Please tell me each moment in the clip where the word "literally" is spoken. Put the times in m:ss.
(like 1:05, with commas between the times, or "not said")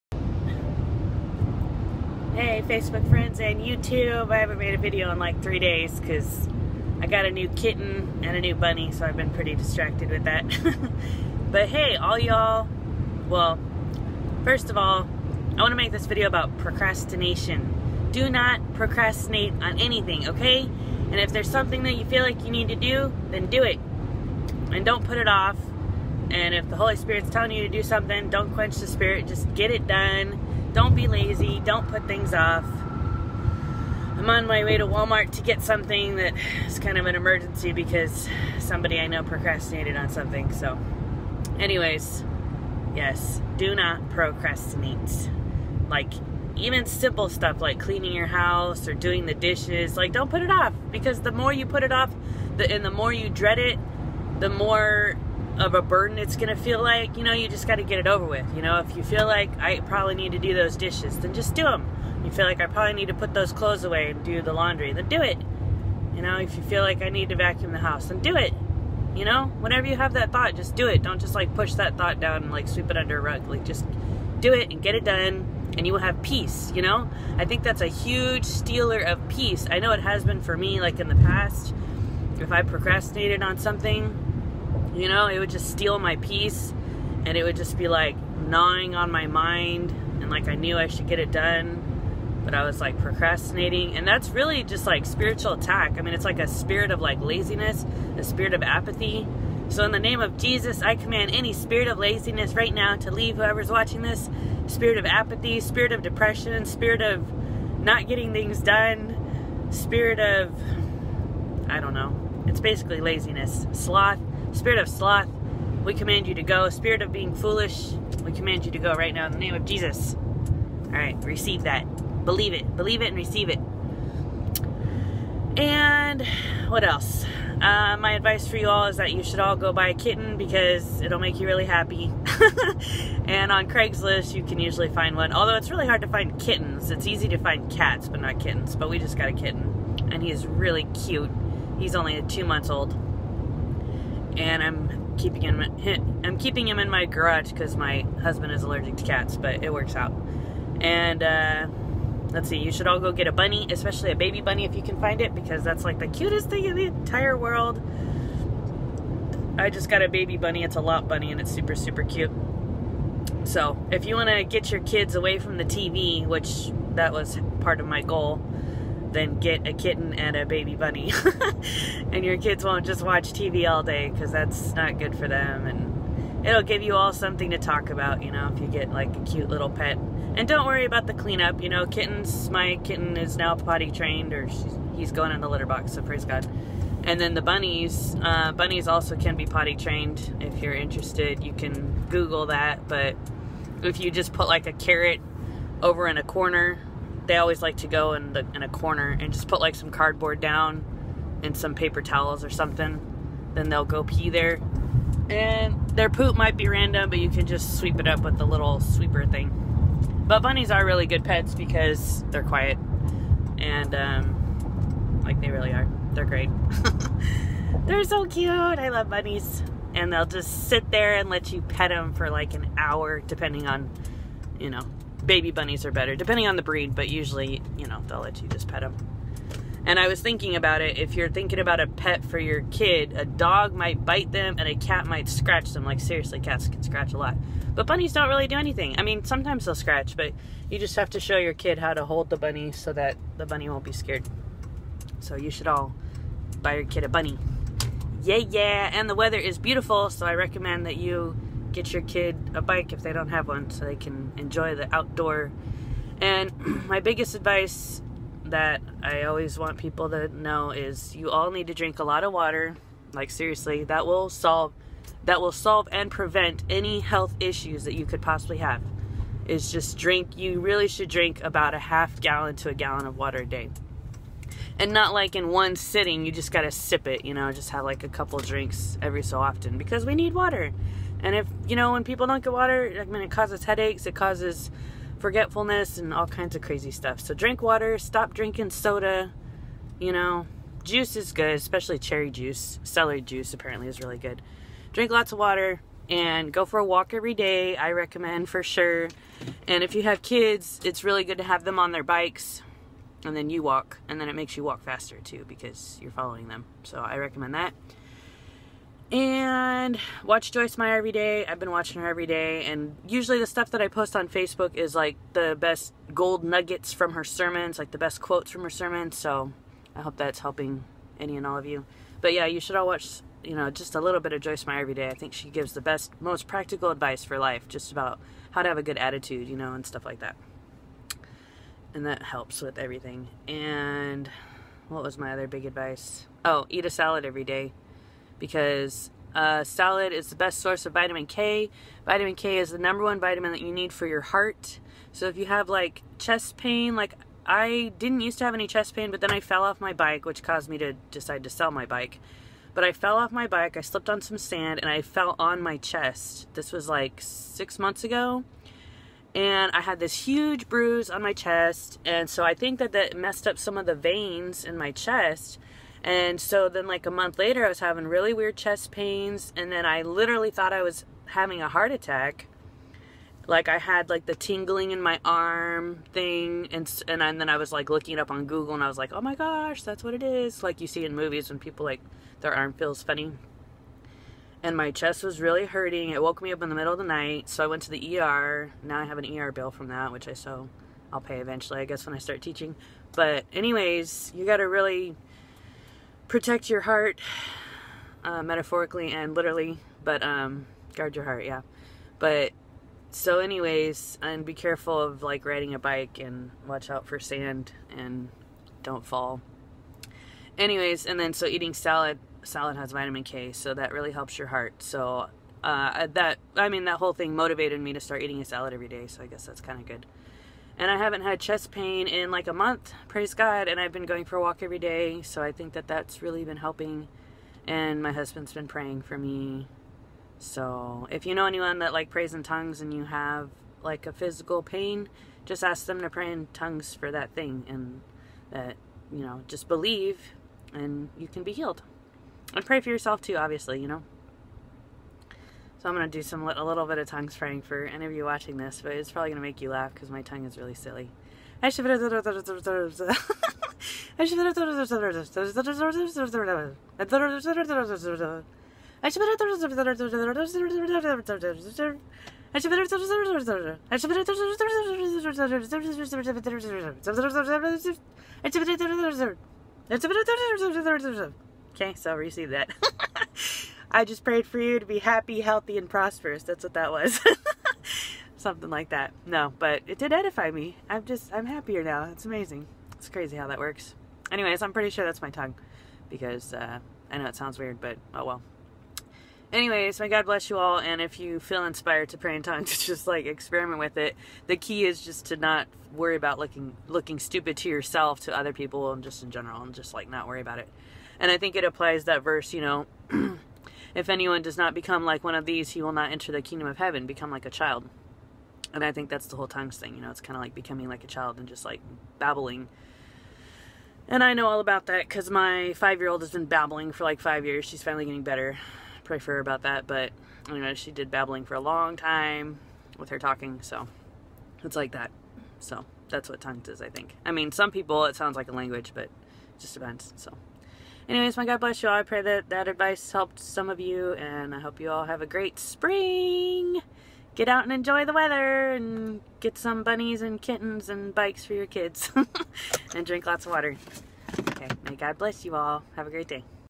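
6:10, 6:39.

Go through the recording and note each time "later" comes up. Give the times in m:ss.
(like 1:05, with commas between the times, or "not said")
6:07.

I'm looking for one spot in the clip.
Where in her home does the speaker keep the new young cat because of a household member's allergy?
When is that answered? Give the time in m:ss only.
2:27.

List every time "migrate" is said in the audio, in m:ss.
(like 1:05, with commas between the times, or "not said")
not said.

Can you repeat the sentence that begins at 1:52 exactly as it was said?
It's basically laziness, sloth, Spirit of sloth, we command you to go.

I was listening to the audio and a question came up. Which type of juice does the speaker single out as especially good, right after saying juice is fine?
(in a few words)
cherry juice.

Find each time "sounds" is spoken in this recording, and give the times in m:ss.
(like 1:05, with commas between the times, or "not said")
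8:07, 8:48.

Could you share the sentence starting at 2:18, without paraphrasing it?
But we just got a kitten, and he's really cute.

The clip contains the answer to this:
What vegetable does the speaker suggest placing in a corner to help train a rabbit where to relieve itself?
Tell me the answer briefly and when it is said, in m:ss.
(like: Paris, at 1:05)
carrot, at 3:14.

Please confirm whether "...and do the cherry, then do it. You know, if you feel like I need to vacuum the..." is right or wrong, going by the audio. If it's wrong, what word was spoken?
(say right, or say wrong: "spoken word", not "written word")
wrong: "laundry", not "cherry".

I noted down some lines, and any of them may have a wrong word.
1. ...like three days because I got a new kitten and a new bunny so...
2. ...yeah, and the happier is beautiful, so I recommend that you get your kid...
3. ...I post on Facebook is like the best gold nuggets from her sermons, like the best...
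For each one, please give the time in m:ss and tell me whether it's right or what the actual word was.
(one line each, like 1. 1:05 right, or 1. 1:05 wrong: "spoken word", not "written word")
1. 0:05 right
2. 4:08 wrong: "weather", not "happier"
3. 5:13 right.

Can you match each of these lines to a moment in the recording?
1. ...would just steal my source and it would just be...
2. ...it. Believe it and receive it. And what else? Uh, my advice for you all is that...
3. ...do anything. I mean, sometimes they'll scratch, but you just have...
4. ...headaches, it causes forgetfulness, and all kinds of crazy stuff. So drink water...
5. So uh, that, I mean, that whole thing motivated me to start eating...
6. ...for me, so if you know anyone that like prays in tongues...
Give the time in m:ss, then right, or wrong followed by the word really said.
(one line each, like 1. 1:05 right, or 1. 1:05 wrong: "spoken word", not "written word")
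1. 1:25 wrong: "peace", not "source"
2. 2:02 right
3. 3:58 right
4. 4:43 right
5. 6:54 right
6. 7:09 right.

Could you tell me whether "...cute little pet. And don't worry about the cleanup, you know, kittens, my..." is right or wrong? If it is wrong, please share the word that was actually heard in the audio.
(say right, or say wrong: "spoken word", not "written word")
right.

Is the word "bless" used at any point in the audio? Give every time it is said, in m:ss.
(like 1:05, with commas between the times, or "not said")
8:10, 8:51, 9:05.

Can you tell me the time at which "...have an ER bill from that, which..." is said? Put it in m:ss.
6:29.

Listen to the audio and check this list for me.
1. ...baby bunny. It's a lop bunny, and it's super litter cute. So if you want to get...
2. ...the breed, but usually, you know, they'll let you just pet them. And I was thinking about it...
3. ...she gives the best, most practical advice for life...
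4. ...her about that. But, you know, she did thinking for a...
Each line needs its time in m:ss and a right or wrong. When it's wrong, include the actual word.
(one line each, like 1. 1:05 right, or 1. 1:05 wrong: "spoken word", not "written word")
1. 2:40 wrong: "super", not "litter"
2. 3:46 right
3. 5:25 right
4. 8:39 wrong: "babbling", not "thinking".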